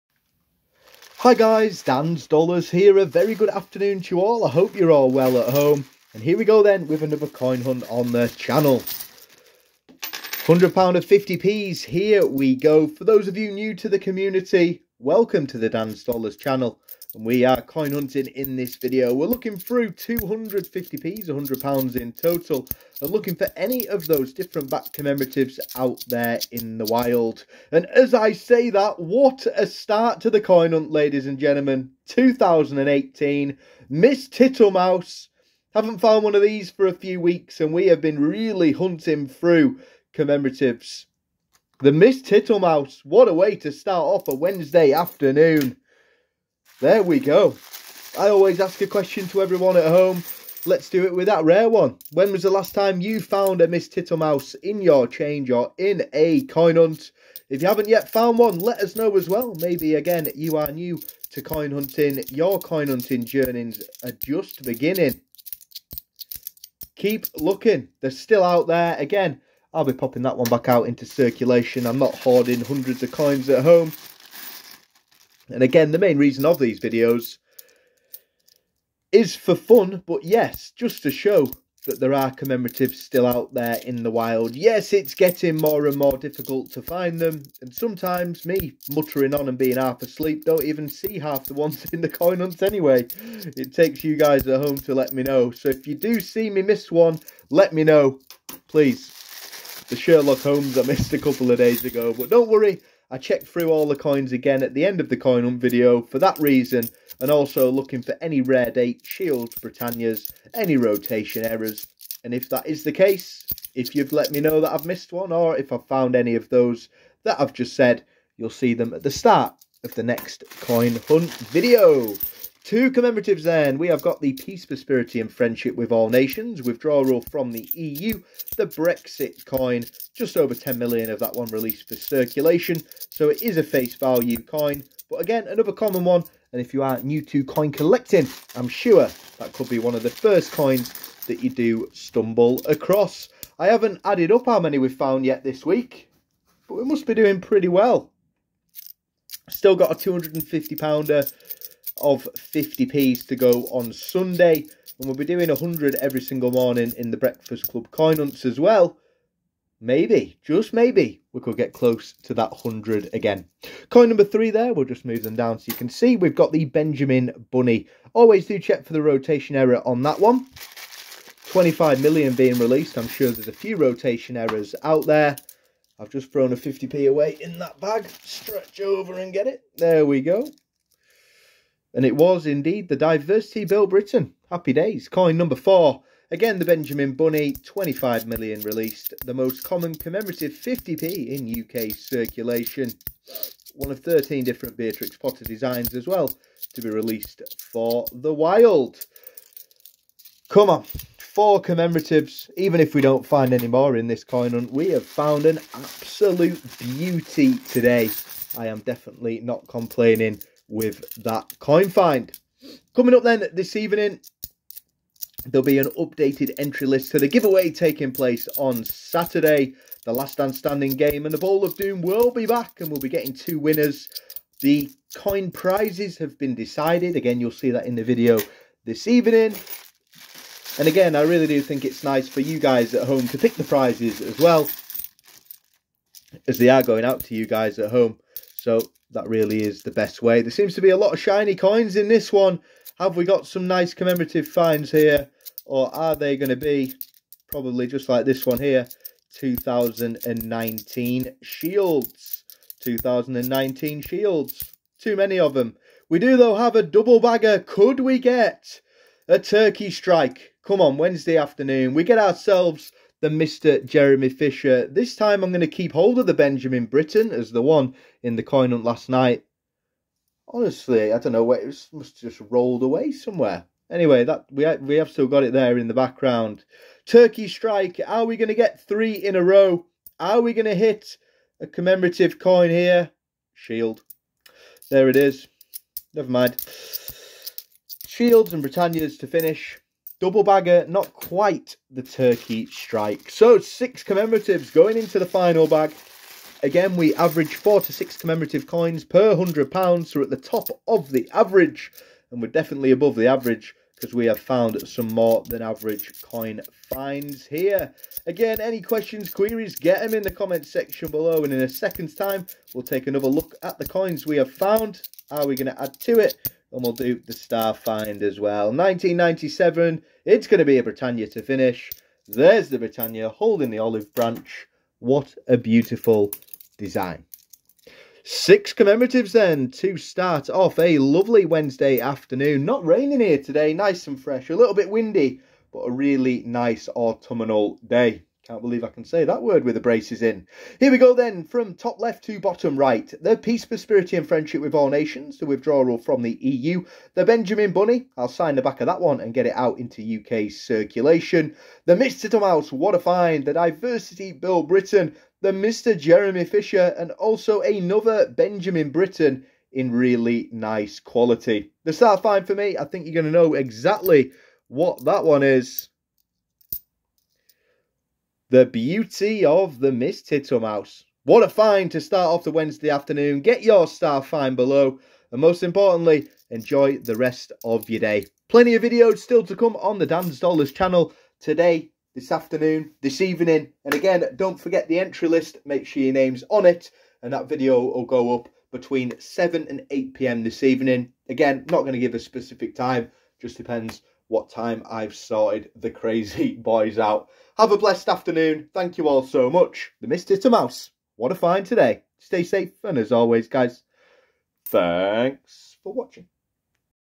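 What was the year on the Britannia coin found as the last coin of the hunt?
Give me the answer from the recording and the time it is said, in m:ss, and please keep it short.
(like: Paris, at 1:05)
1997, at 5:18.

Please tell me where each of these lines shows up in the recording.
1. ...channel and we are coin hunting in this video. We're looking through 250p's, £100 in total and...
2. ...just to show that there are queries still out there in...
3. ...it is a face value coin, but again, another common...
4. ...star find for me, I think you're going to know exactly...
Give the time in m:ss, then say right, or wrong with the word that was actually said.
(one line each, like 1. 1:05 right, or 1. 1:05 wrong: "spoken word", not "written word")
1. 0:16 right
2. 1:20 wrong: "commemoratives", not "queries"
3. 2:13 right
4. 6:01 right.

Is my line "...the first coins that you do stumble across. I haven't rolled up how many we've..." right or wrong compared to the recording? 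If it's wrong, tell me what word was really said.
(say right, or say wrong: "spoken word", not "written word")
wrong: "added", not "rolled".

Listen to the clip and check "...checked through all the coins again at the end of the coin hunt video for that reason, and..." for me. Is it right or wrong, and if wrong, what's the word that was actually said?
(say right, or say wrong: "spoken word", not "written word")
right.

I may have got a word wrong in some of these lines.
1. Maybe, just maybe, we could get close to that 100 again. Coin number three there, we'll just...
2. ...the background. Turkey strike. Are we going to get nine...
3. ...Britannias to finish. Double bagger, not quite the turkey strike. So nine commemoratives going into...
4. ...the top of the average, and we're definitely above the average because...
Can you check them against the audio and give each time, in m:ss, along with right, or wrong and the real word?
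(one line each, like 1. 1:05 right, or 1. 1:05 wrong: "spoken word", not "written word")
1. 2:39 right
2. 4:35 wrong: "three", not "nine"
3. 4:48 wrong: "six", not "nine"
4. 5:00 right.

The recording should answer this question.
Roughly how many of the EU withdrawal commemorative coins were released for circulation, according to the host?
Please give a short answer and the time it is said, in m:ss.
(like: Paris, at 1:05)
just over 10 million, at 2:10.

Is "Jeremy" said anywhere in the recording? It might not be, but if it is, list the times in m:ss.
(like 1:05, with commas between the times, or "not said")
4:23, 5:55.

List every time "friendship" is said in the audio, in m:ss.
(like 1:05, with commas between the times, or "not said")
2:05, 5:44.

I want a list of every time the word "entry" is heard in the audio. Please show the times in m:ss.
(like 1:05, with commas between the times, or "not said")
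3:36, 6:24.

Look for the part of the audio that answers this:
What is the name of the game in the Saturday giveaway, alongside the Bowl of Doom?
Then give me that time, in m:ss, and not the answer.
3:40.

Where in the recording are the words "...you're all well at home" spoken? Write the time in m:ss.
0:04.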